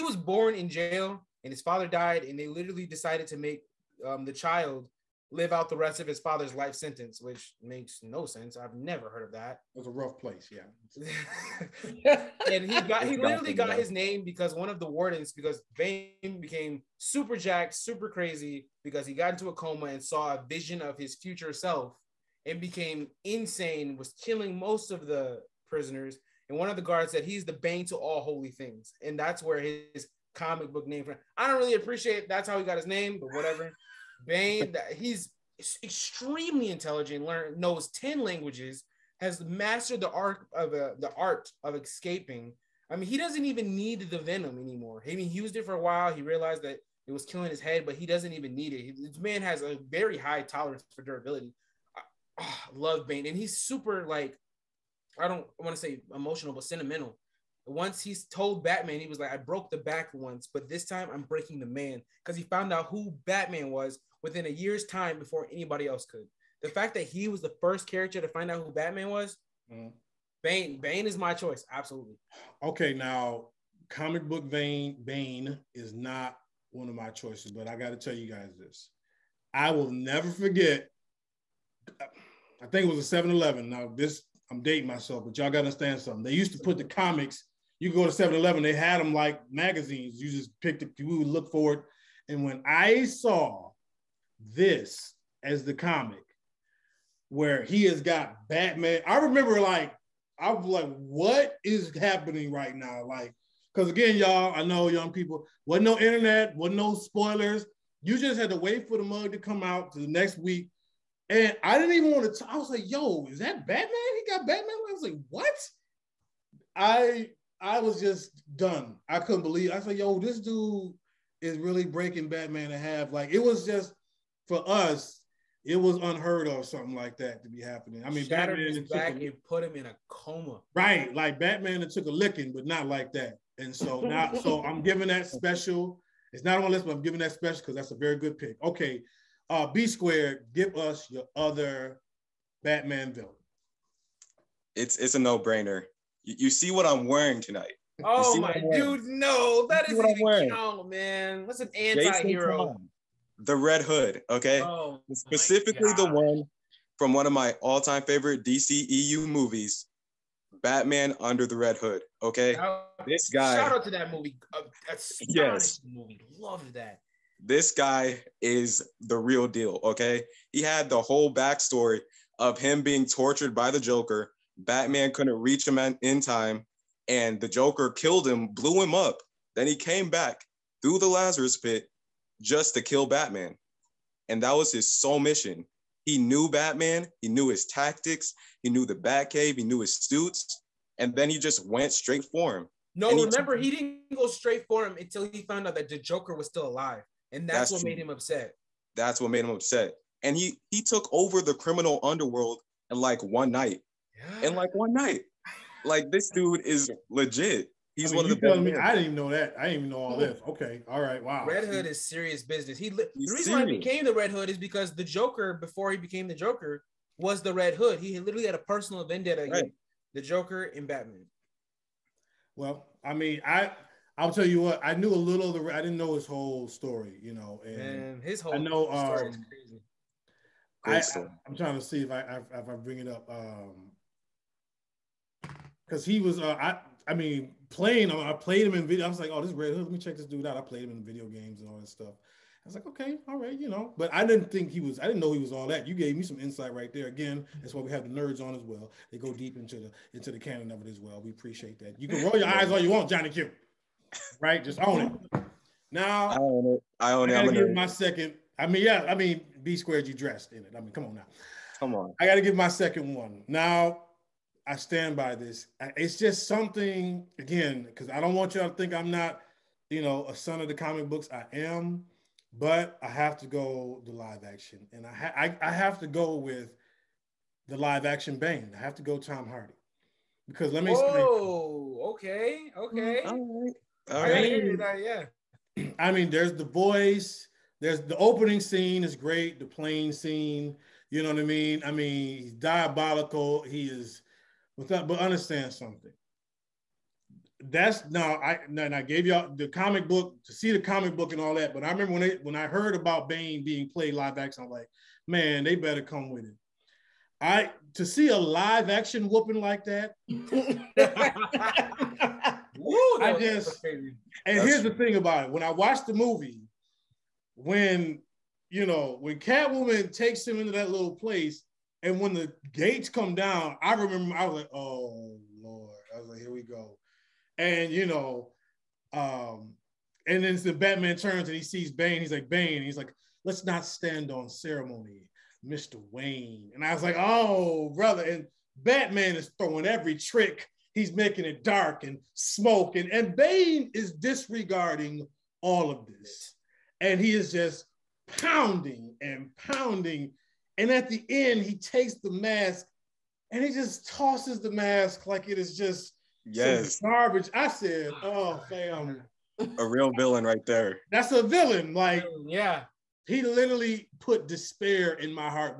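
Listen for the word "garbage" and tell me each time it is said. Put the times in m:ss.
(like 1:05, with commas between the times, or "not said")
5:56.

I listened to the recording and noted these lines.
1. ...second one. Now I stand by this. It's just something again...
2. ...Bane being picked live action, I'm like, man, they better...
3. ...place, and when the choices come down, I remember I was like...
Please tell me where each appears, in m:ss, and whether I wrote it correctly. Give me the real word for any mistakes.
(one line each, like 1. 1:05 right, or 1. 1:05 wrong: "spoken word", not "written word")
1. 4:22 right
2. 5:03 wrong: "played", not "picked"
3. 5:21 wrong: "gates", not "choices".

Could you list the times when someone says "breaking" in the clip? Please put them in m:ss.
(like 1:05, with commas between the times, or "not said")
1:01, 2:01.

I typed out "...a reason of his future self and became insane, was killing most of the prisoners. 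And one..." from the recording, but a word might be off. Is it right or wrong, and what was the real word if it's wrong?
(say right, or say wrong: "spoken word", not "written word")
wrong: "vision", not "reason".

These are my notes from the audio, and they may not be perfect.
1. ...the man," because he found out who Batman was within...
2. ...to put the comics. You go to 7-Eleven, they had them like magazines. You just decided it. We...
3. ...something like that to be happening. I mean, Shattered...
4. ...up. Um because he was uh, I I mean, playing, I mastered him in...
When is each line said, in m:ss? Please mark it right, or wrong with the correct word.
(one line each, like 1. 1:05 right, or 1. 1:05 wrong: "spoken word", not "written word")
1. 1:01 right
2. 1:26 wrong: "picked", not "decided"
3. 2:06 right
4. 3:53 wrong: "played", not "mastered".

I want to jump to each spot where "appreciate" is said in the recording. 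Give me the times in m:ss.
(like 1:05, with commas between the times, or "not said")
0:31, 4:11.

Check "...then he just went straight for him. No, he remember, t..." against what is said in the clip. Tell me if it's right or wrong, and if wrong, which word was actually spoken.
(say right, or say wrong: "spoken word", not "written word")
right.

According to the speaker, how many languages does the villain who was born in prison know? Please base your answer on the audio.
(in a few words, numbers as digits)
10.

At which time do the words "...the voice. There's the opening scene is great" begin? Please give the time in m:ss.
4:46.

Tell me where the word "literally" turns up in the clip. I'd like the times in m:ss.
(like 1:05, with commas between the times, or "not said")
0:02, 0:13, 3:38, 6:03.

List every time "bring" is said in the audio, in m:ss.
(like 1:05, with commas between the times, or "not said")
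3:52.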